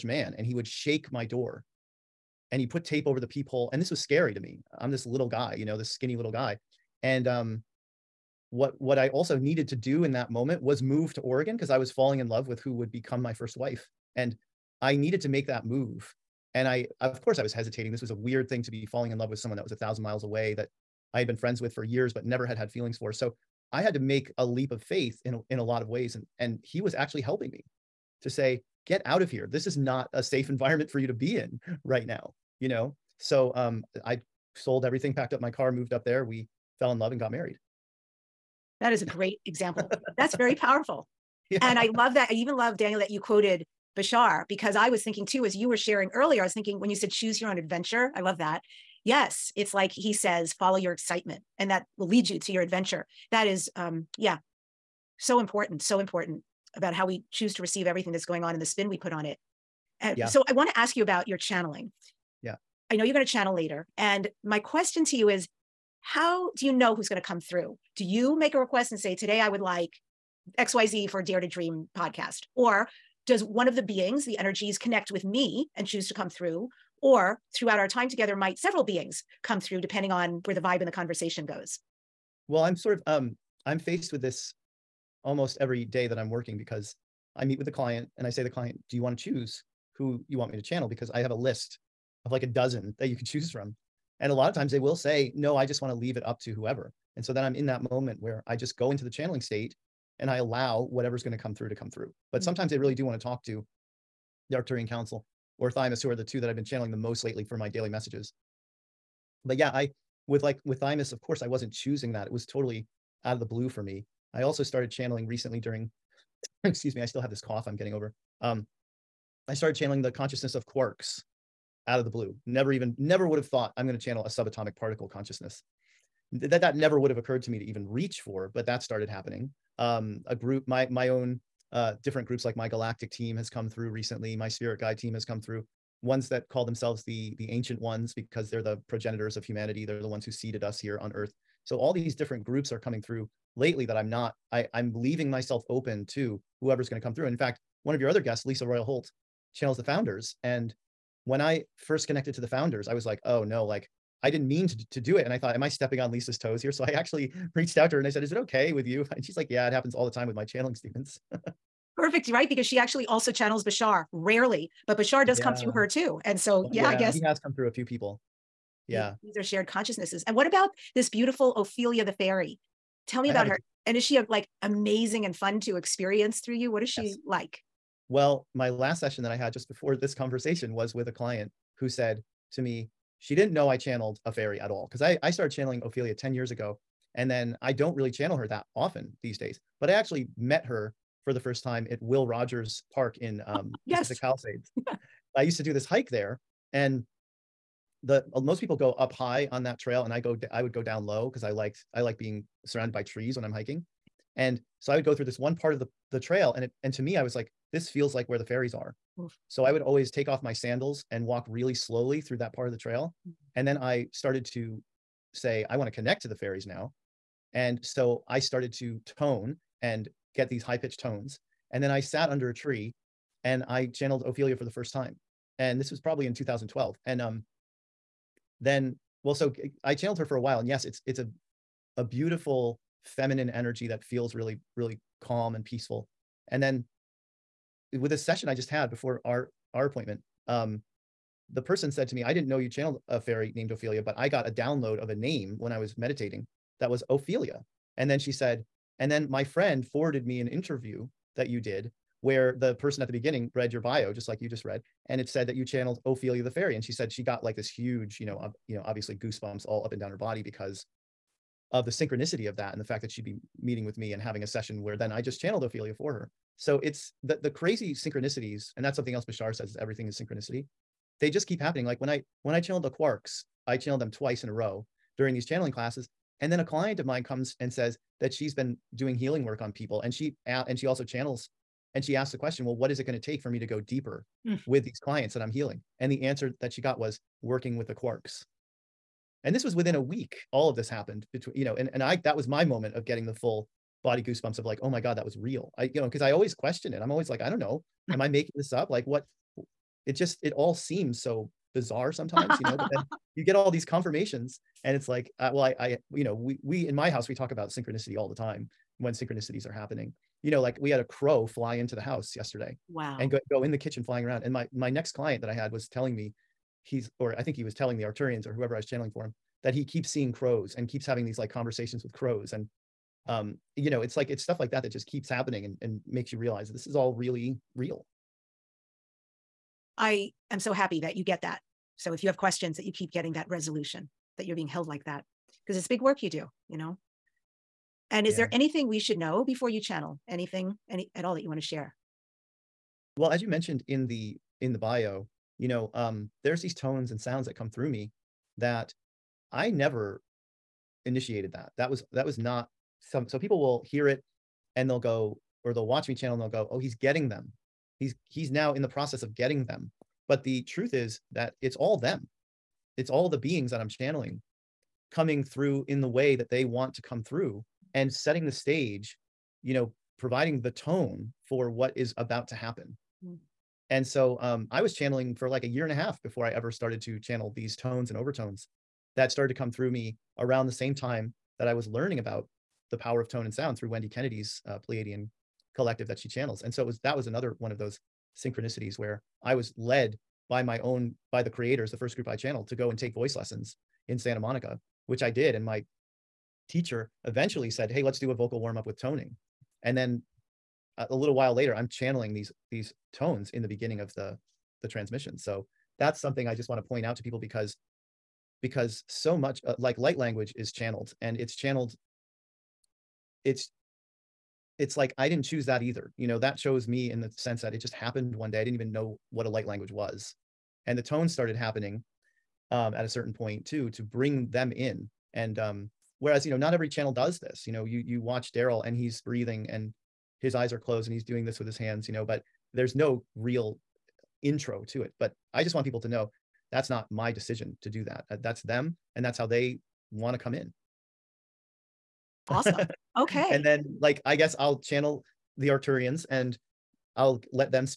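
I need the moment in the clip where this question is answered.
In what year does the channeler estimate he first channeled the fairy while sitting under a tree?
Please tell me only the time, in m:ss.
3:46.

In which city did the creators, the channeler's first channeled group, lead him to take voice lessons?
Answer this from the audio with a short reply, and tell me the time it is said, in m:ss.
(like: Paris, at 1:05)
Santa Monica, at 6:34.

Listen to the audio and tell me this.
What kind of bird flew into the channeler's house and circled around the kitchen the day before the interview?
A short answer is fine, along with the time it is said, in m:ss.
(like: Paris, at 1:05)
A crow, at 5:11.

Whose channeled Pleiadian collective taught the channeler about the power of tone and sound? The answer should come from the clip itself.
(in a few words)
Wendy Kennedy.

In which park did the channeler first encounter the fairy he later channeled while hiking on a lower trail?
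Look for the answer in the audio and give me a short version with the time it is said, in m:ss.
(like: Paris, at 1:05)
Will Rogers Park, at 3:12.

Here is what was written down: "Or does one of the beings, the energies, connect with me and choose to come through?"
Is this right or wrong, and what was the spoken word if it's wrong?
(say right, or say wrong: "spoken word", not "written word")
right.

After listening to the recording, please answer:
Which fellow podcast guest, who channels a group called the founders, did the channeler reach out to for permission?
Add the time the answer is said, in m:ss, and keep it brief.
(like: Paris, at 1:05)
Lisa Royal Holt, at 2:28.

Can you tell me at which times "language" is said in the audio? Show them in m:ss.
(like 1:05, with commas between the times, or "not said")
6:50, 6:59.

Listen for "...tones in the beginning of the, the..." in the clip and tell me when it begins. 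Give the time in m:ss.
6:43.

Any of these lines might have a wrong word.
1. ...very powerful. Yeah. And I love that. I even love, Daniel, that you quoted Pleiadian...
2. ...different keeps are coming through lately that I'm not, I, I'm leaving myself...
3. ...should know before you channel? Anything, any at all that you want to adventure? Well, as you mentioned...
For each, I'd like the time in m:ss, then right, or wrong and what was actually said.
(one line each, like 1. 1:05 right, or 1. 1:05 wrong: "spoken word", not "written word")
1. 0:40 wrong: "Bashar", not "Pleiadian"
2. 2:22 wrong: "groups", not "keeps"
3. 5:38 wrong: "share", not "adventure".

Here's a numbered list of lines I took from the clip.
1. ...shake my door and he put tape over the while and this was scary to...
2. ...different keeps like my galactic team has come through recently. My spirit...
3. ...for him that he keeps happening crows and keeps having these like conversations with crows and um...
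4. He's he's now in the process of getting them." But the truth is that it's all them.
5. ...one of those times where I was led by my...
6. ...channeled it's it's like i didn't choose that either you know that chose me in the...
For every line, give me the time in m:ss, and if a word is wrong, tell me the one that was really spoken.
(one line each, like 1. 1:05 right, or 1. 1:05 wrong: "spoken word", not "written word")
1. 0:00 wrong: "peephole", not "while"
2. 2:12 wrong: "groups", not "keeps"
3. 5:19 wrong: "seeing", not "happening"
4. 5:58 right
5. 6:27 wrong: "synchronicities", not "times"
6. 6:51 right.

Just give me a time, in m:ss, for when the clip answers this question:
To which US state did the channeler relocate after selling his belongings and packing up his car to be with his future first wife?
0:11.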